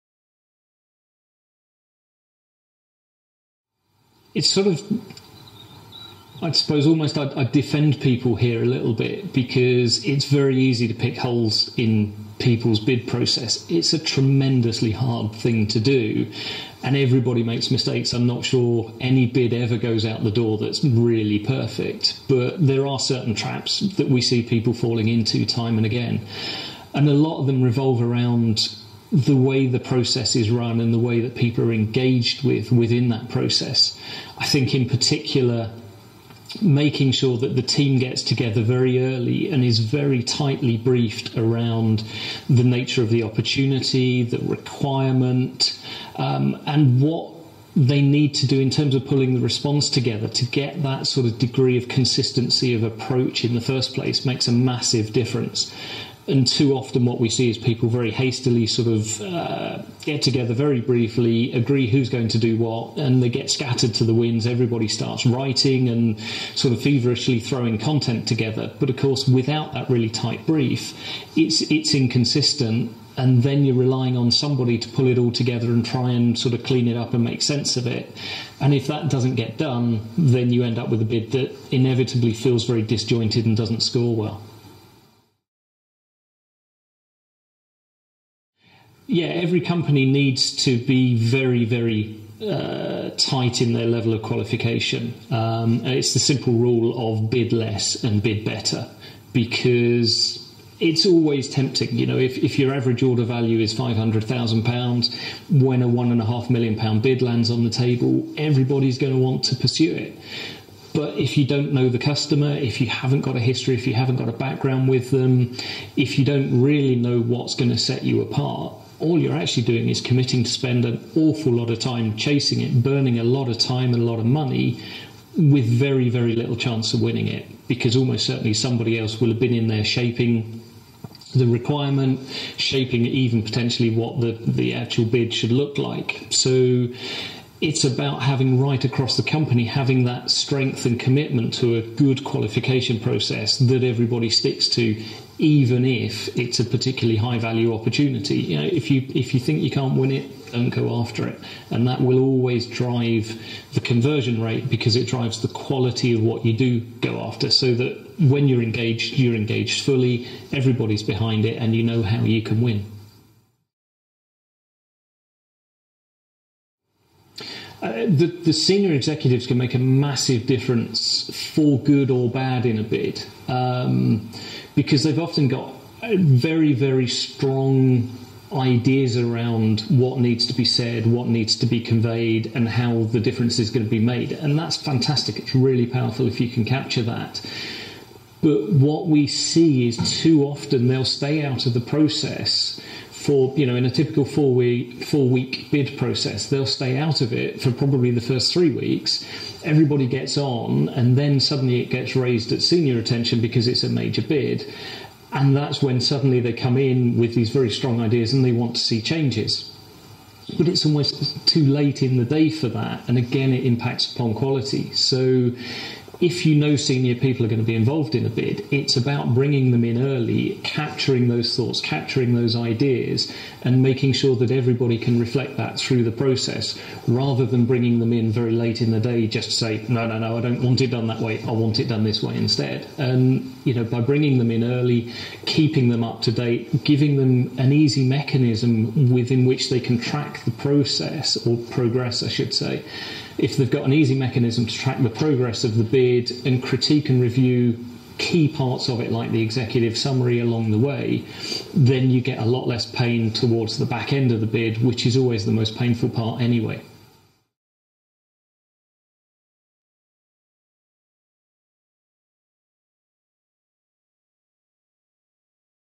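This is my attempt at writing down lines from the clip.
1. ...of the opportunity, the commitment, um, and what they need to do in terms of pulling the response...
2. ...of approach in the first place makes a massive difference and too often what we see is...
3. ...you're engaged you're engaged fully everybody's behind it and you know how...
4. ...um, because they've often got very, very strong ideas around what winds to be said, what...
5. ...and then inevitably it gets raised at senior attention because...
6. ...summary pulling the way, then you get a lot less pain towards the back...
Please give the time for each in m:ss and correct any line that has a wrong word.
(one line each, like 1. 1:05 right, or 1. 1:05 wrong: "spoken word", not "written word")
1. 0:43 wrong: "requirement", not "commitment"
2. 0:52 right
3. 2:38 right
4. 2:53 wrong: "needs", not "winds"
5. 3:20 wrong: "suddenly", not "inevitably"
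6. 4:09 wrong: "along", not "pulling".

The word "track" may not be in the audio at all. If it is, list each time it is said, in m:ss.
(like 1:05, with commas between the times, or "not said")
3:59, 4:04.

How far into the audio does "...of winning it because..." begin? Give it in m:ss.
2:06.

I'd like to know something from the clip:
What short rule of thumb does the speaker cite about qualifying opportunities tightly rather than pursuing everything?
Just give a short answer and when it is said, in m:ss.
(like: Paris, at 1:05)
bid less and bid better, at 1:37.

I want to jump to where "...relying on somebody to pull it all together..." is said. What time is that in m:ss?
1:13.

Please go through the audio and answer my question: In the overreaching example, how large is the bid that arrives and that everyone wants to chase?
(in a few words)
£1.5 million.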